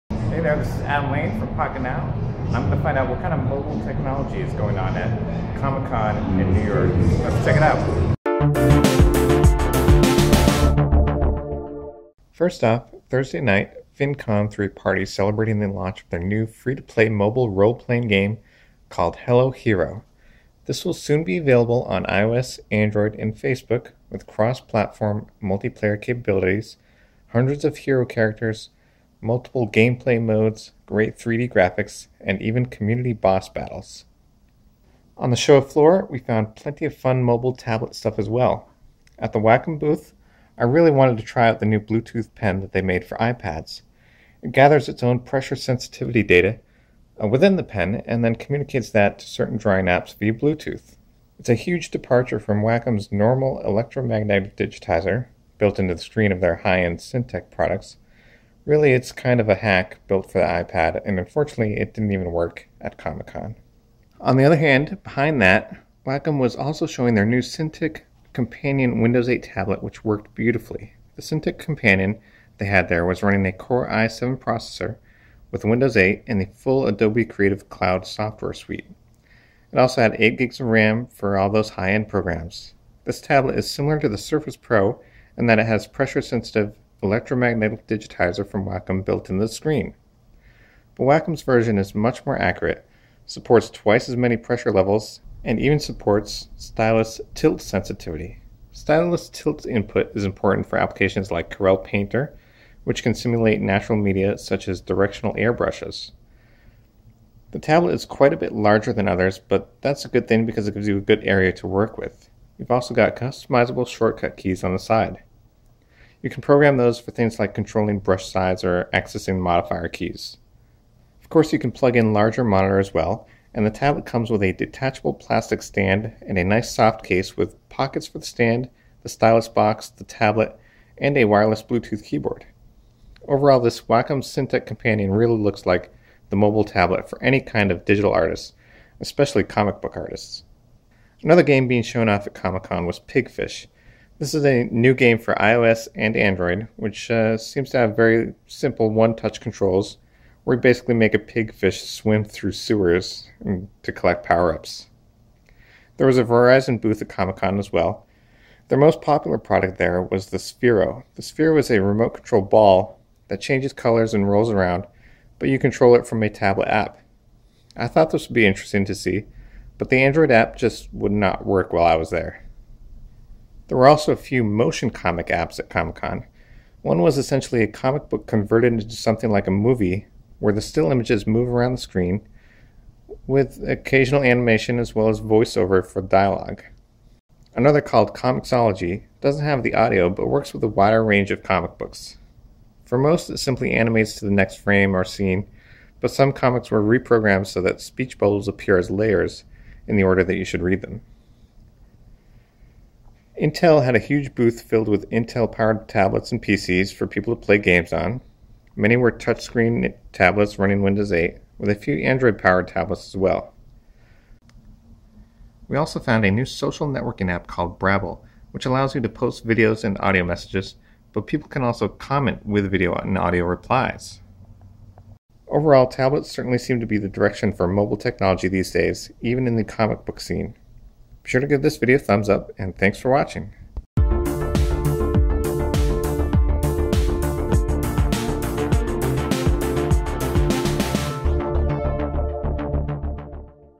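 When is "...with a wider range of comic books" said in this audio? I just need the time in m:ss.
3:10.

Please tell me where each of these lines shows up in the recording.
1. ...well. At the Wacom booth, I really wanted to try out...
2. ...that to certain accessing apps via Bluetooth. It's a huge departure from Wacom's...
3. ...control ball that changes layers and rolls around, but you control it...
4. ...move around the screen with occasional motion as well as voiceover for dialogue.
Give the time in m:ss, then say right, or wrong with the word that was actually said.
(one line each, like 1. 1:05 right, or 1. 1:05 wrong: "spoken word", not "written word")
1. 0:38 right
2. 0:48 wrong: "drawing", not "accessing"
3. 2:42 wrong: "colors", not "layers"
4. 3:01 wrong: "animation", not "motion".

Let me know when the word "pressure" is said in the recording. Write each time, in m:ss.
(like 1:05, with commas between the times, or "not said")
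0:45, 1:25, 1:34.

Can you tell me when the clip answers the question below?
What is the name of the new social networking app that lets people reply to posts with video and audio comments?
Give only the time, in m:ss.
3:37.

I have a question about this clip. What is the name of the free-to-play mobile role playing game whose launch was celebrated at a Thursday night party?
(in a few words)
Hello Hero.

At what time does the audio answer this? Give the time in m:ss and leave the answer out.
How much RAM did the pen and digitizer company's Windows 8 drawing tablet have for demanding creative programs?
1:20.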